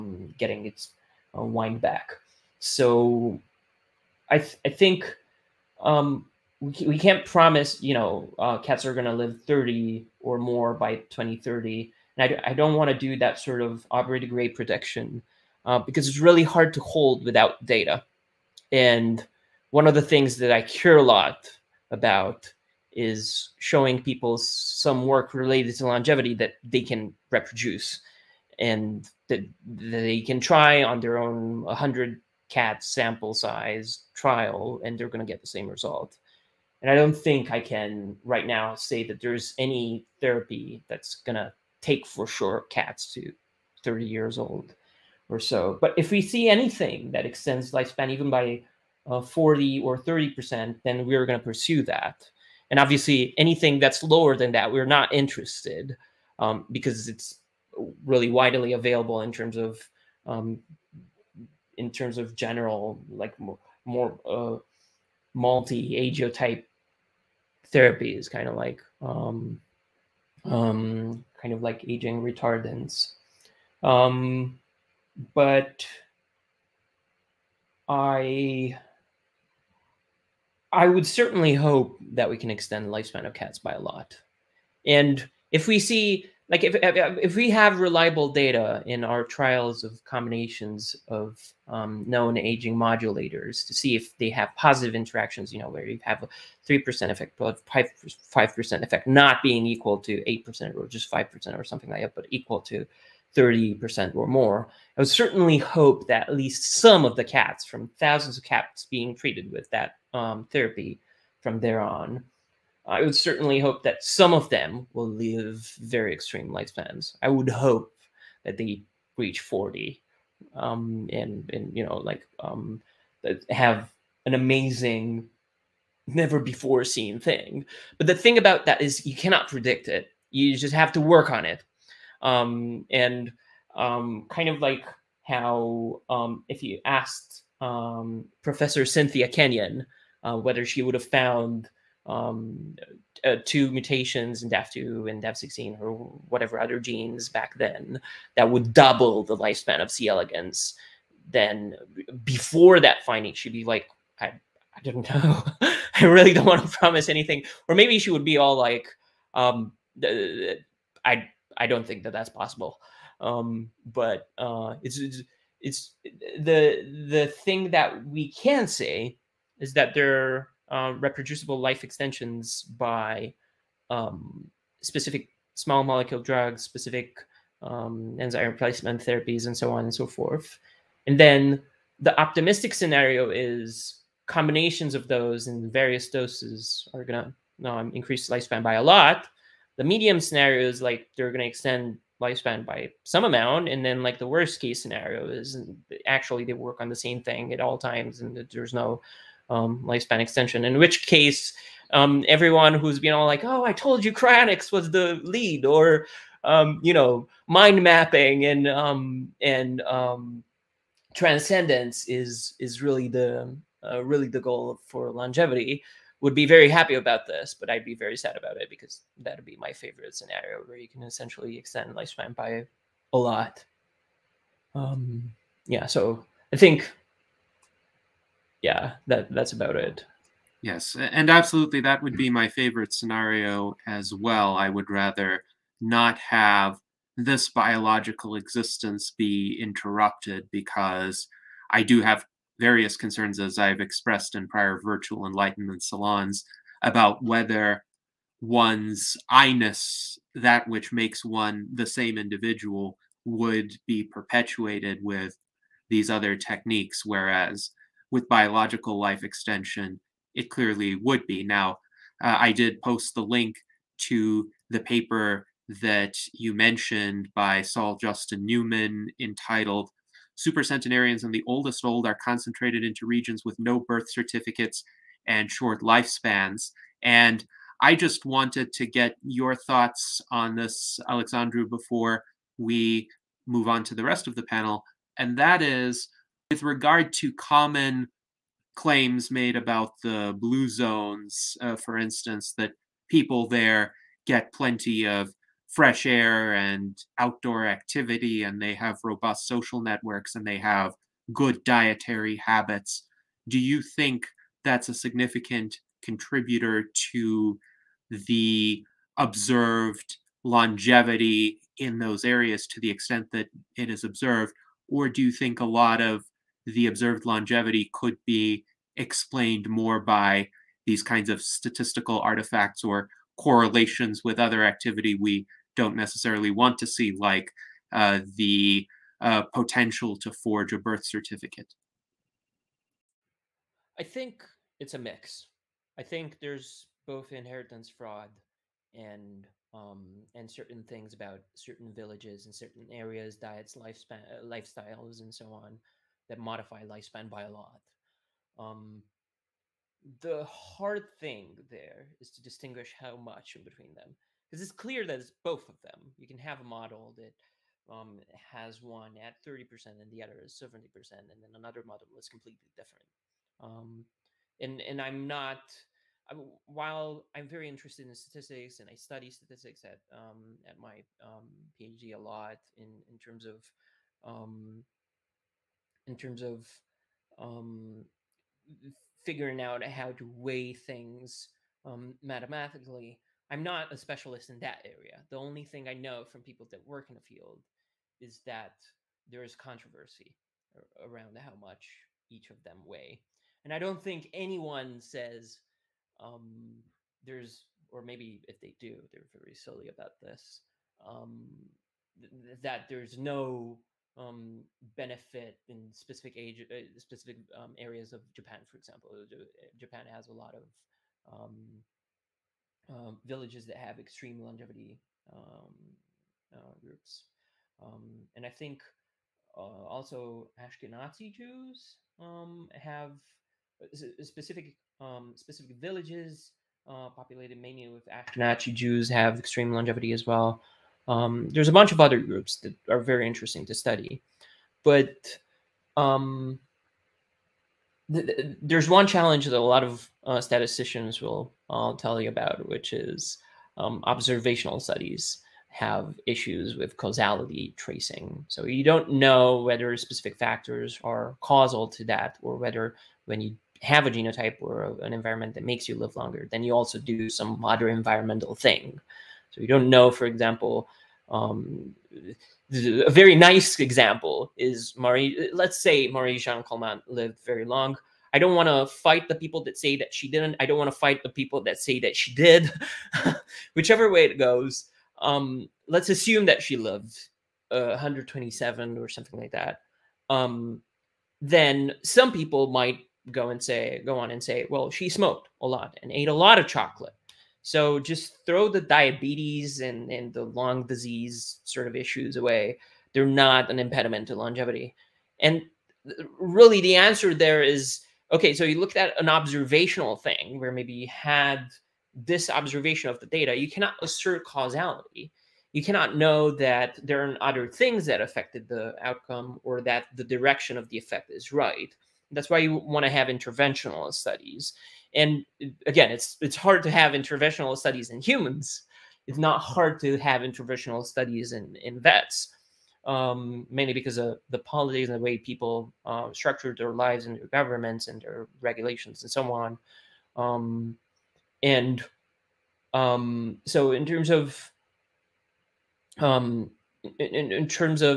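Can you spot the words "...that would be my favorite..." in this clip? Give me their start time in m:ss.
3:51.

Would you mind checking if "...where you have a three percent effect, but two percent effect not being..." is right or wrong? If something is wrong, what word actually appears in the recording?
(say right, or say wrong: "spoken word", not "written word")
wrong: "five", not "two".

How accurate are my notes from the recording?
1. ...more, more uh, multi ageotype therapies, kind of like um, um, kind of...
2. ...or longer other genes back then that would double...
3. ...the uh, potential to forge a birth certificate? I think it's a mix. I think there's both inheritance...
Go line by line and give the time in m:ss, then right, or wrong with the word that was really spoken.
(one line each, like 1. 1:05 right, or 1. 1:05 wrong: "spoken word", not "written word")
1. 1:03 right
2. 2:25 wrong: "whatever", not "longer"
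3. 5:28 right.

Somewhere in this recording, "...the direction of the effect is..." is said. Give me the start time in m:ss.
8:30.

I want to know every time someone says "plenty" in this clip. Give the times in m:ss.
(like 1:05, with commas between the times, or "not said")
4:54.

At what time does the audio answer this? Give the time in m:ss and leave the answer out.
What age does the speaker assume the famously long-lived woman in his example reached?
7:57.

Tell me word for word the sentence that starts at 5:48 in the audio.
Um, the hard thing there is to distinguish how much in between them, because it's clear that it's both of them.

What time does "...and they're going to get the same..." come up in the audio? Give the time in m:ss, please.
0:34.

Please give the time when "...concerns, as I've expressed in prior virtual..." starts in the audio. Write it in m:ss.
4:02.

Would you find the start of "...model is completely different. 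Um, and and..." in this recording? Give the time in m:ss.
6:01.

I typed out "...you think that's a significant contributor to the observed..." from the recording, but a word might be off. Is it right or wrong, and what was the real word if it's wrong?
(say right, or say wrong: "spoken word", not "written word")
right.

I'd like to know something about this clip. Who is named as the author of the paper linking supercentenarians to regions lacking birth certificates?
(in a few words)
Saul Justin Newman.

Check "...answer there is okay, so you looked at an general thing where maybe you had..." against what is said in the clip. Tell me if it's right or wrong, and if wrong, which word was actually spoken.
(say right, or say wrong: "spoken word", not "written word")
wrong: "observational", not "general".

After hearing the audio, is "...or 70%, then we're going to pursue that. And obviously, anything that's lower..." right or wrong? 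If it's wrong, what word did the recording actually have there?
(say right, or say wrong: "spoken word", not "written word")
wrong: "30", not "70".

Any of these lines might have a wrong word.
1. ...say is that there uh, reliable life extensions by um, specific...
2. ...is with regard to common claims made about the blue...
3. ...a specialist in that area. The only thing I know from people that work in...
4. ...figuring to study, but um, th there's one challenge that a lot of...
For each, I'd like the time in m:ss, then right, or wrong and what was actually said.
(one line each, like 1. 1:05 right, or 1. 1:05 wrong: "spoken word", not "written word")
1. 2:48 wrong: "reproducible", not "reliable"
2. 4:45 right
3. 6:23 right
4. 7:13 wrong: "interesting", not "figuring".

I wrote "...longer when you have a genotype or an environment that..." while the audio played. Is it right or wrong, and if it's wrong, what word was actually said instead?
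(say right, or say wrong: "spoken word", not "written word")
wrong: "whether", not "longer".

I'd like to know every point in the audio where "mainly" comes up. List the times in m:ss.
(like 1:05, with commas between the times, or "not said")
7:07, 8:43.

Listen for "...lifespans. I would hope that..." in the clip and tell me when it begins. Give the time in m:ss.
1:56.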